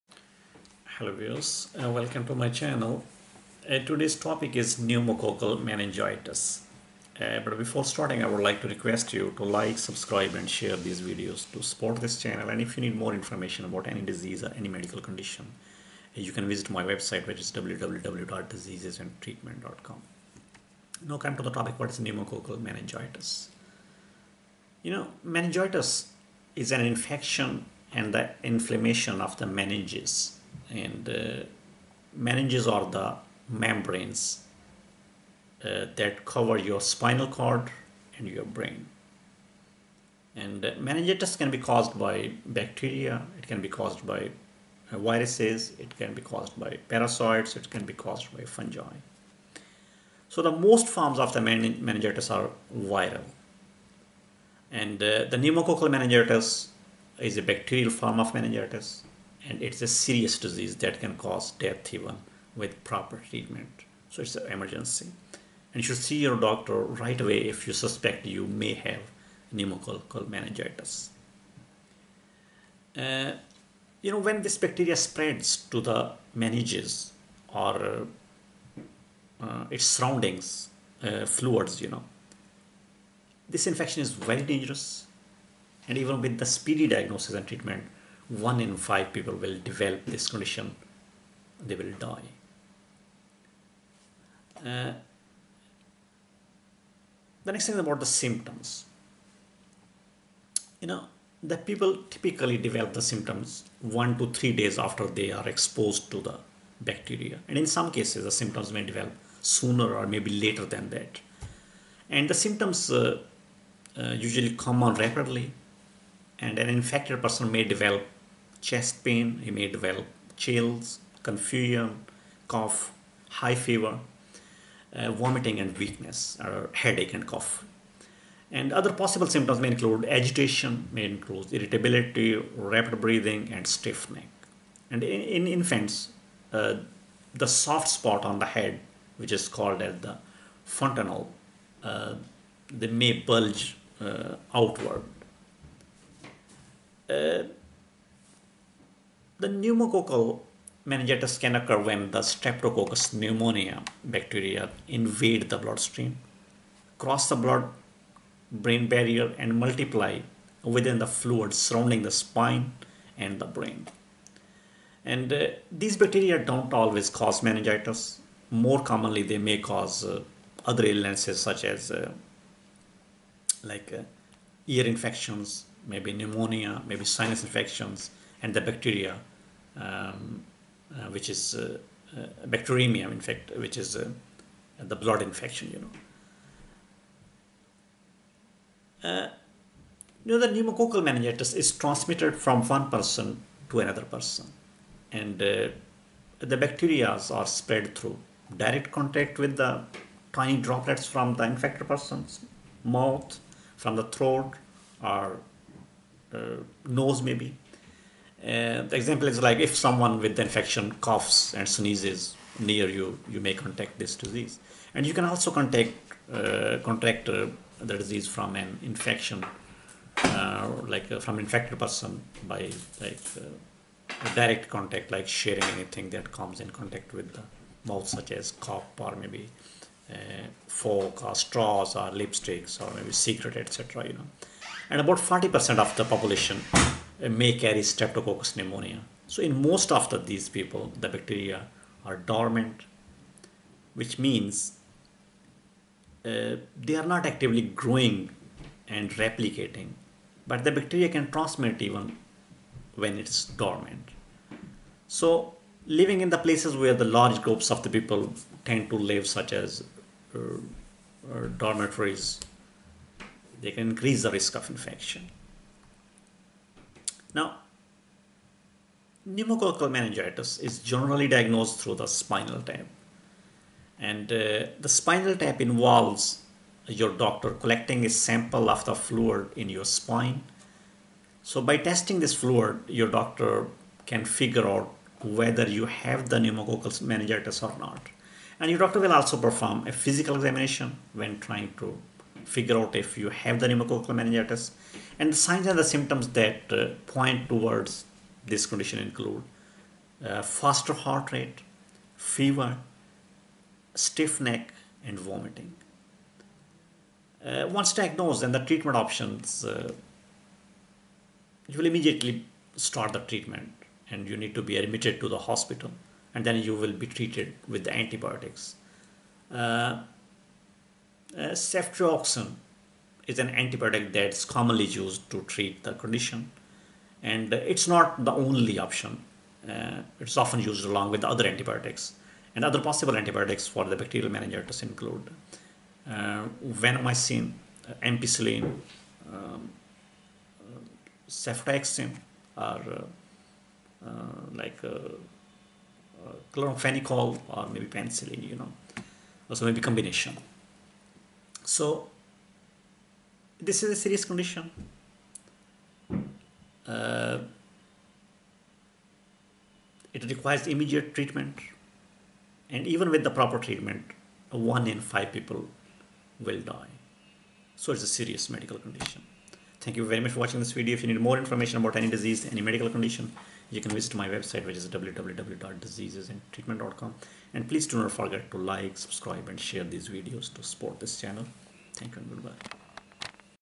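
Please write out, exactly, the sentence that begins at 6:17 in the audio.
And please do not forget to like, subscribe, and share these videos to support this channel.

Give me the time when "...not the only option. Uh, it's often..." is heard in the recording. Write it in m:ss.
5:27.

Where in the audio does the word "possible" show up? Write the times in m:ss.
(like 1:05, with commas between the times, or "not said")
2:08, 5:32.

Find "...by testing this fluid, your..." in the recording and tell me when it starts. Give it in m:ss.
4:41.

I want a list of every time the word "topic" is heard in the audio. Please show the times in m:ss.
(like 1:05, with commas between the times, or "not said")
0:04, 0:21.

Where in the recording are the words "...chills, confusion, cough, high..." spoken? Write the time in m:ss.
2:00.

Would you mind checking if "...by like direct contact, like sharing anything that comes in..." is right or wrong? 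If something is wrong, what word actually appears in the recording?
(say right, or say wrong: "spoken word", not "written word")
right.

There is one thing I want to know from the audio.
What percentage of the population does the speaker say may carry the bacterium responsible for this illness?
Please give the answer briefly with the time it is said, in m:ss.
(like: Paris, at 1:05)
40%, at 3:55.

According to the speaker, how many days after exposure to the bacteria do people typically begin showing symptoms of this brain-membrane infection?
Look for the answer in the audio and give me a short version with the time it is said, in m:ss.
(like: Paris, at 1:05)
1 to 3 days, at 1:43.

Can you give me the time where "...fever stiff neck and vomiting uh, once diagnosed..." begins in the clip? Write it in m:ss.
5:02.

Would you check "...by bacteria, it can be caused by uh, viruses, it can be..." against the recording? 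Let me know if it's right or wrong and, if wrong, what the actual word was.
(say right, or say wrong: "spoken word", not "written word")
right.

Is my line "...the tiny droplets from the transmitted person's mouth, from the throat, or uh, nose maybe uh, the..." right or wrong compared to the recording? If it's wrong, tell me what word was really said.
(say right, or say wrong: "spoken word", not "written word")
wrong: "infected", not "transmitted".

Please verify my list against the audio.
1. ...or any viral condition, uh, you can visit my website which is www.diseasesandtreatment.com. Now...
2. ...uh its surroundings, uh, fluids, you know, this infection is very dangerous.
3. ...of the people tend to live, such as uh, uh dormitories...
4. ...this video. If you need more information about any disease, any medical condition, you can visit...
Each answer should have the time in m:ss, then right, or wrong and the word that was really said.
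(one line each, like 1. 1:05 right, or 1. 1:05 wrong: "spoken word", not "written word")
1. 0:14 wrong: "medical", not "viral"
2. 1:19 right
3. 4:17 right
4. 6:10 right.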